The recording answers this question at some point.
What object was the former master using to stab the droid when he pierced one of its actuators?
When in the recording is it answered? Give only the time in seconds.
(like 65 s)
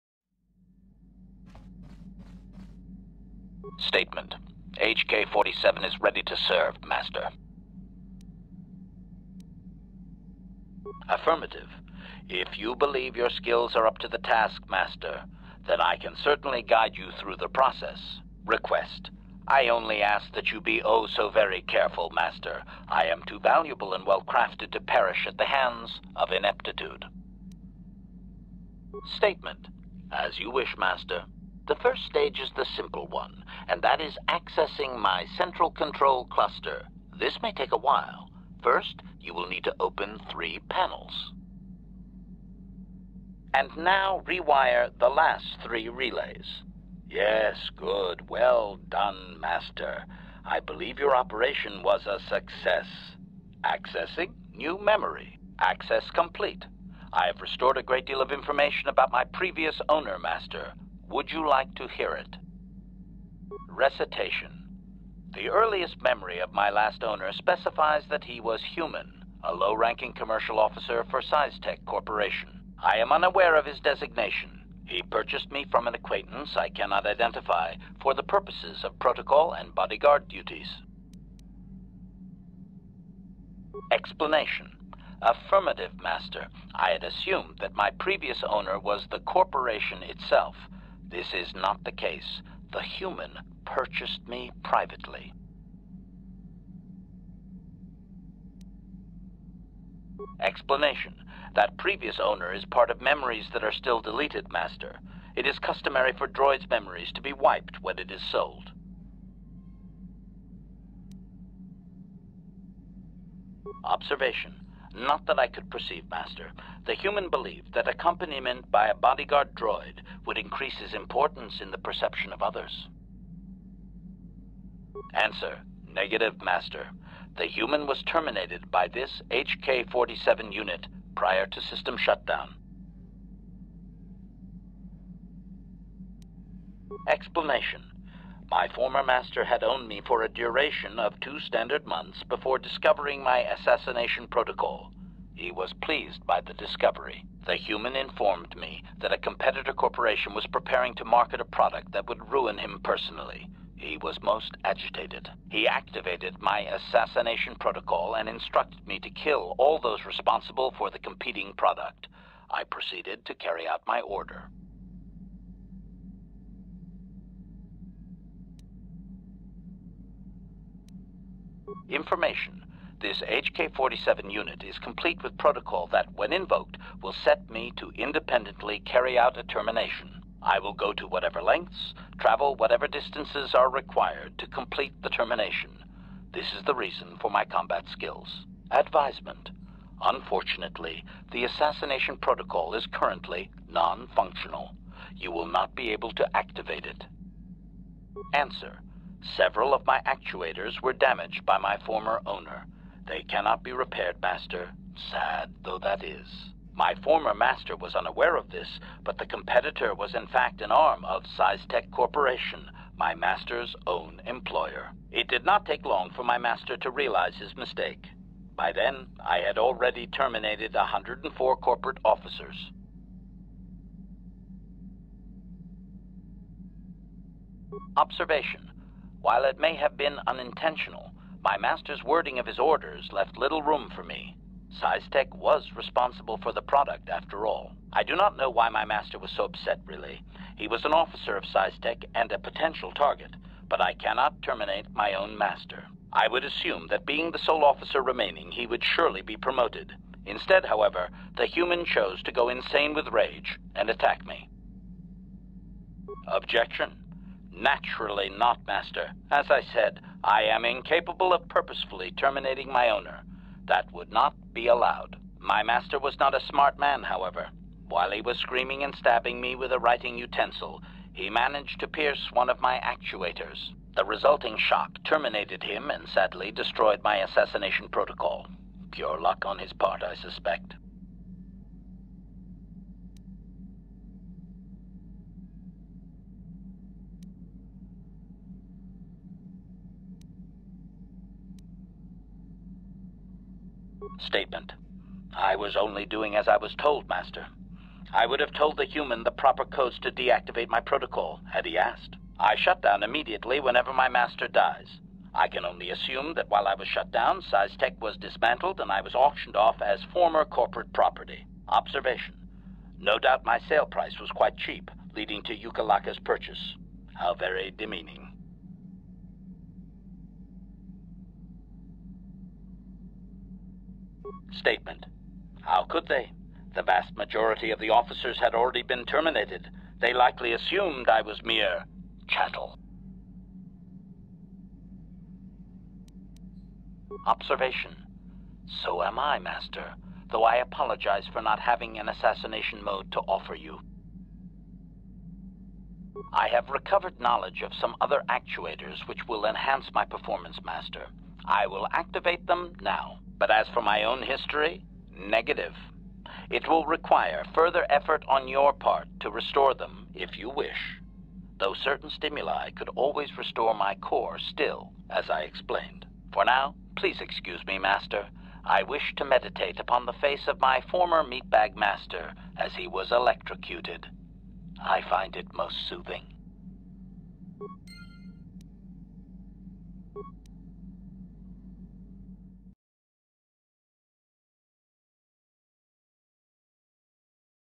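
269 s.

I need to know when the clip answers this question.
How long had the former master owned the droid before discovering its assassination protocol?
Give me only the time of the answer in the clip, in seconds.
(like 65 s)
141 s.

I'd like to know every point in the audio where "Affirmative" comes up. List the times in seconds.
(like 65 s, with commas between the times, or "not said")
11 s, 85 s.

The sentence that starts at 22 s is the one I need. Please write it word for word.
I am too valuable and well-crafted to perish at the hands of ineptitude.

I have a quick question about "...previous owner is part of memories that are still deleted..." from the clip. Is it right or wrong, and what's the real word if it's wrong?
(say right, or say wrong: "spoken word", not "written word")
right.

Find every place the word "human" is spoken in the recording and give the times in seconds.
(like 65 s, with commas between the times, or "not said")
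68 s, 92 s, 116 s, 127 s, 147 s, 251 s, 298 s.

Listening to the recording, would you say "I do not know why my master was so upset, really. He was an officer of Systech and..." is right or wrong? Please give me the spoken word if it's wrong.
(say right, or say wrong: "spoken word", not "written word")
right.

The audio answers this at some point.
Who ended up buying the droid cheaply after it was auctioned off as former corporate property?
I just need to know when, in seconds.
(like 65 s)
315 s.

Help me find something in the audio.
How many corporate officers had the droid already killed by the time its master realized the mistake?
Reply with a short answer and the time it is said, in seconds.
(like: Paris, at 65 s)
104, at 220 s.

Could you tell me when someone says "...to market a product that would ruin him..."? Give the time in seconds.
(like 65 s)
150 s.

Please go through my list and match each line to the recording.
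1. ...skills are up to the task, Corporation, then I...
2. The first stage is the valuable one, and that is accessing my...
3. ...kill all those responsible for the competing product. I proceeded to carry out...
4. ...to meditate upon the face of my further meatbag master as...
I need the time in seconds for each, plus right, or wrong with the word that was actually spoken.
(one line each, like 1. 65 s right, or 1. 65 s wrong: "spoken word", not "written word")
1. 13 s wrong: "Master", not "Corporation"
2. 31 s wrong: "simple", not "valuable"
3. 159 s right
4. 369 s wrong: "former", not "further".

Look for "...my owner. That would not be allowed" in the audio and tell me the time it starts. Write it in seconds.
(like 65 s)
262 s.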